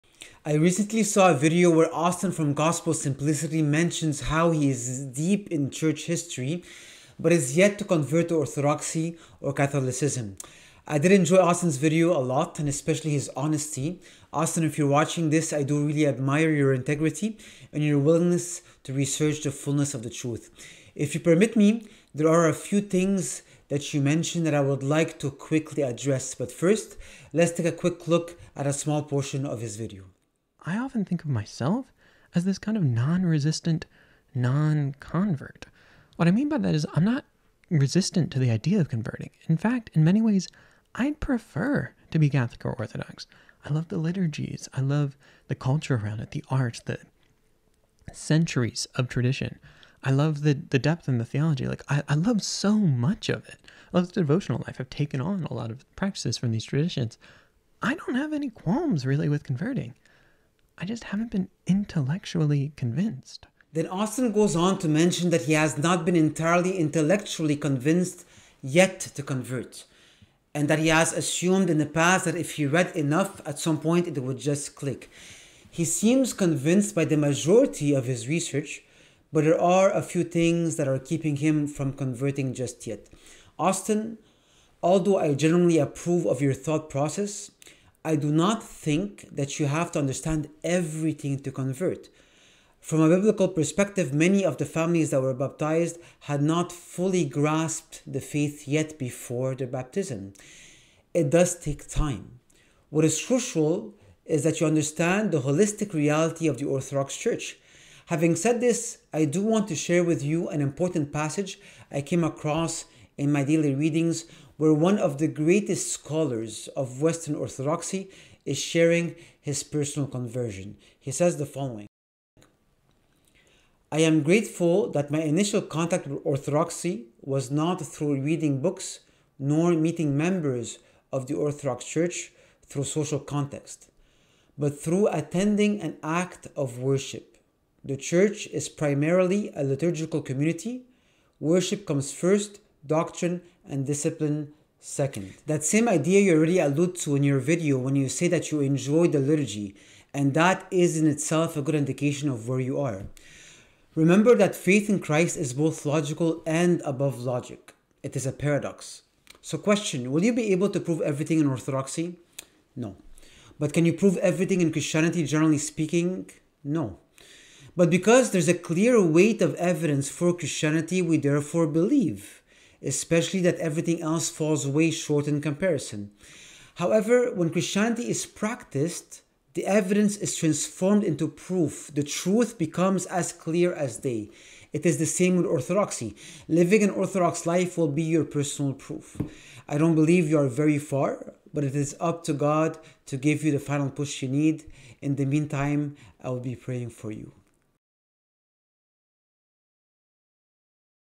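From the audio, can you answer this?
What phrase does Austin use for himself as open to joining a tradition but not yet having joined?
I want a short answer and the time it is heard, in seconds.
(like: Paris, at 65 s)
non resistant, non convert, at 32 s.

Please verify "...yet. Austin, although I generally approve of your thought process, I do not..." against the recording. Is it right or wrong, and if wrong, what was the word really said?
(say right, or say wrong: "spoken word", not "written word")
right.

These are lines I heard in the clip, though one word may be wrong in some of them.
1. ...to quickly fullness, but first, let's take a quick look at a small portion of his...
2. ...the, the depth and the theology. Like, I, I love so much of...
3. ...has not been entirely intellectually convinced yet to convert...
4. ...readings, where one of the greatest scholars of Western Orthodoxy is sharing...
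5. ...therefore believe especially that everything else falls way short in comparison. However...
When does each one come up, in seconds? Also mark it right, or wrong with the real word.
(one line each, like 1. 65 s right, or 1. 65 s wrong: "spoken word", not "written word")
1. 25 s wrong: "address", not "fullness"
2. 50 s right
3. 65 s right
4. 113 s right
5. 171 s right.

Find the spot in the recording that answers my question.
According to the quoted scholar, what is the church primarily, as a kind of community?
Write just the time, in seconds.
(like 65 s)
139 s.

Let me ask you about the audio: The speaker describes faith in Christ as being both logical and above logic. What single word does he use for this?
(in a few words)
Paradox.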